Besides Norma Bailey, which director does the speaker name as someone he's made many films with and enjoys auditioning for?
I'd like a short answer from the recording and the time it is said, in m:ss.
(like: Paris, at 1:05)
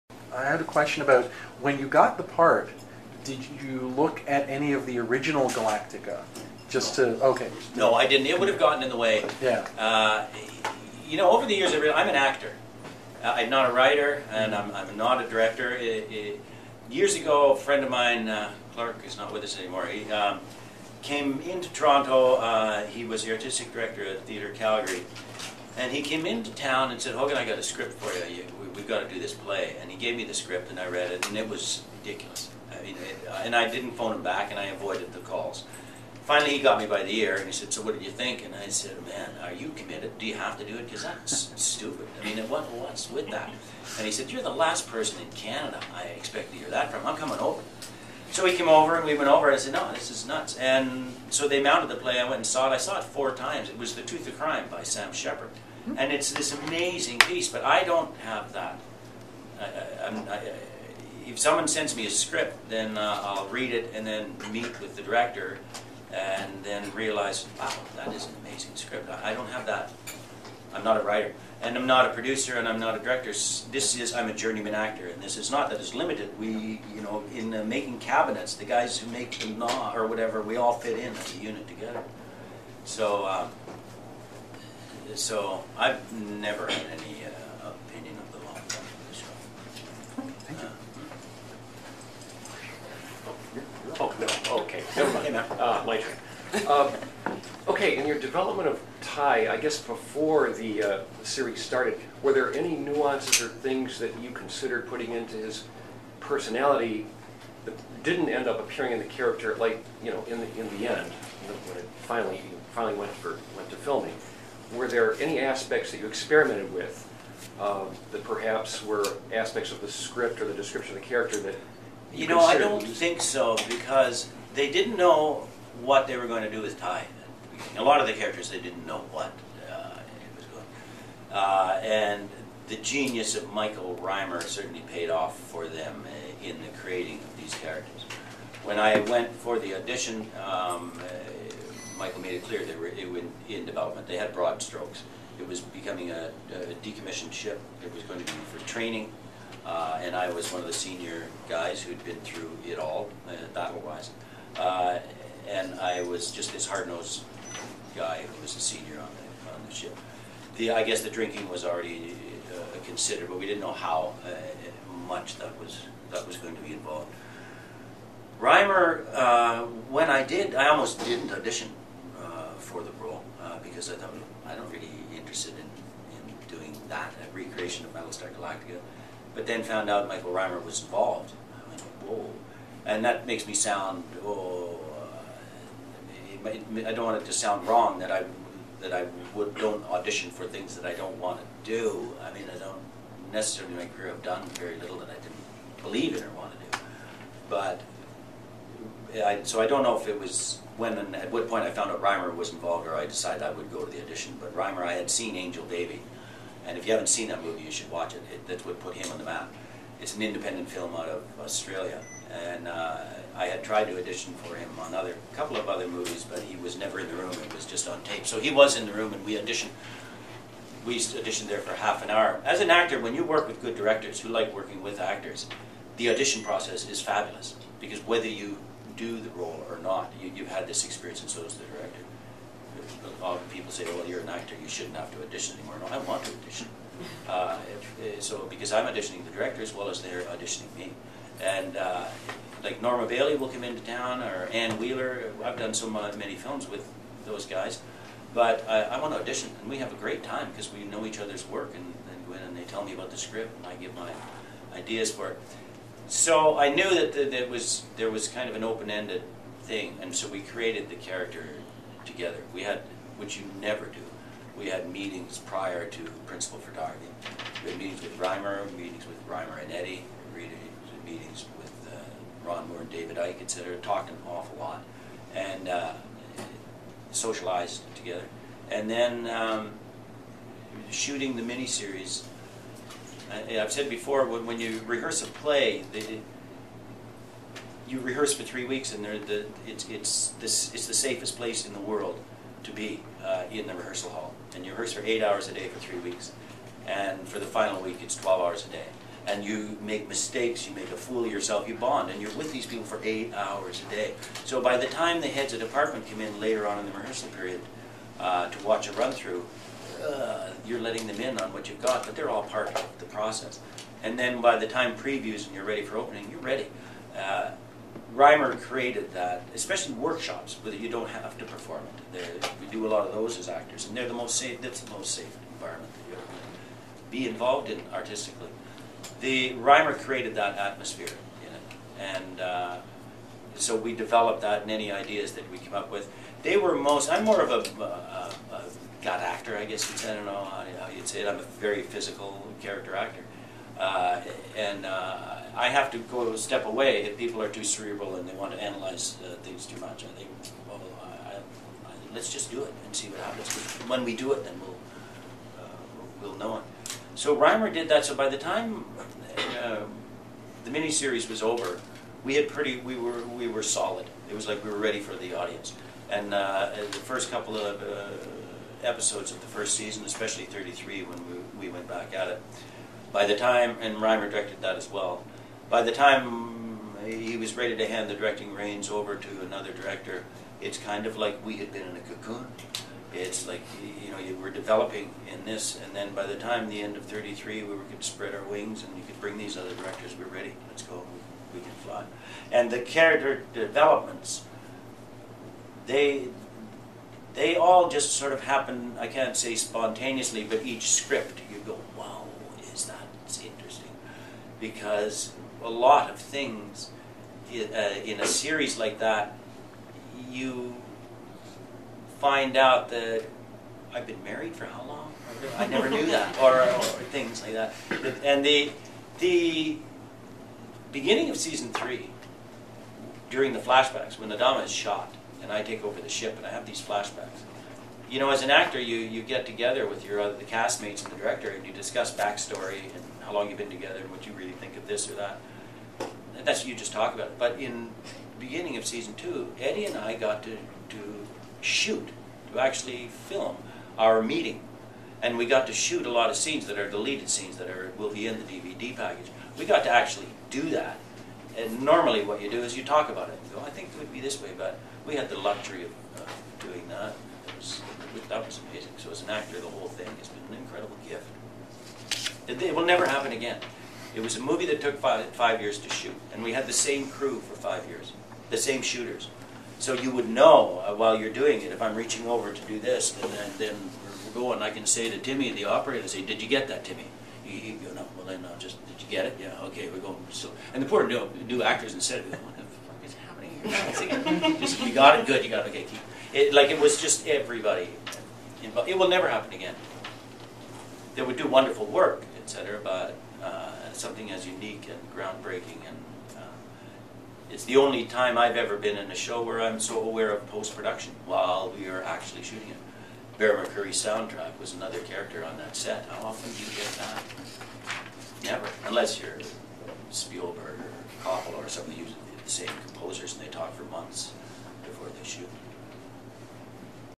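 Anne Wheeler, at 4:04.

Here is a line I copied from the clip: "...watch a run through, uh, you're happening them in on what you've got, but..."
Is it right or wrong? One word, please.
wrong.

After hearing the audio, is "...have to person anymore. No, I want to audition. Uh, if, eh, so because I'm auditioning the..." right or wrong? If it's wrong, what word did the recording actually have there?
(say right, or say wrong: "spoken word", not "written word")
wrong: "audition", not "person".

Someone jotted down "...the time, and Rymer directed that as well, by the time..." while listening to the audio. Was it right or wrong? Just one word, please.
right.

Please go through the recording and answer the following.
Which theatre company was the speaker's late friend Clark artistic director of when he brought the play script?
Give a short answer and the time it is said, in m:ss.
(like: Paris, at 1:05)
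Theatre Calgary, at 0:24.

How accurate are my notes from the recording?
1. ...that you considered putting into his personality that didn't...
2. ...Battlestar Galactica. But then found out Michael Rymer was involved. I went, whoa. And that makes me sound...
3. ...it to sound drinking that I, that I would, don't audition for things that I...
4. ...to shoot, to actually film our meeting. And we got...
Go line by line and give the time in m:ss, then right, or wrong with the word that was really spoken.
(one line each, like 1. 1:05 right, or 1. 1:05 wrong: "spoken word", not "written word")
1. 1:43 right
2. 2:57 right
3. 3:07 wrong: "wrong", not "drinking"
4. 7:20 right.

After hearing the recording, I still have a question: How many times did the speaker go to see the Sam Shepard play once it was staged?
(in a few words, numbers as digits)
4.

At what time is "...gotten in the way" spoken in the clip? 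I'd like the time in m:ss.
0:08.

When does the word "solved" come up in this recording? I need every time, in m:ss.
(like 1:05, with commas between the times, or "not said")
not said.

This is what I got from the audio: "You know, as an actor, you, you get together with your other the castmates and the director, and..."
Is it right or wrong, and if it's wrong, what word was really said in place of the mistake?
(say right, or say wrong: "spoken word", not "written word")
right.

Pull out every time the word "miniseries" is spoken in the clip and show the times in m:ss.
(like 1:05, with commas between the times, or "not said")
4:41, 6:00.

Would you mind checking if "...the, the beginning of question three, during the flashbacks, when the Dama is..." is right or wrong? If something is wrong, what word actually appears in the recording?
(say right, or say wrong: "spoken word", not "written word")
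wrong: "season", not "question".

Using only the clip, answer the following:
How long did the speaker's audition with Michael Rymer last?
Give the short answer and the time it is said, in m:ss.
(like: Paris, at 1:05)
half an hour, at 3:41.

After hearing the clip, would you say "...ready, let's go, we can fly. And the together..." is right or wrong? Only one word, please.
wrong.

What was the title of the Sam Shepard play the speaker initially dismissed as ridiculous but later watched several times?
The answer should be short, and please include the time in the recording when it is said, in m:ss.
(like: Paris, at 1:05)
The Tooth of Crime, at 0:53.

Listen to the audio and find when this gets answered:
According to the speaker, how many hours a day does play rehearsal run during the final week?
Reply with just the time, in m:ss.
4:58.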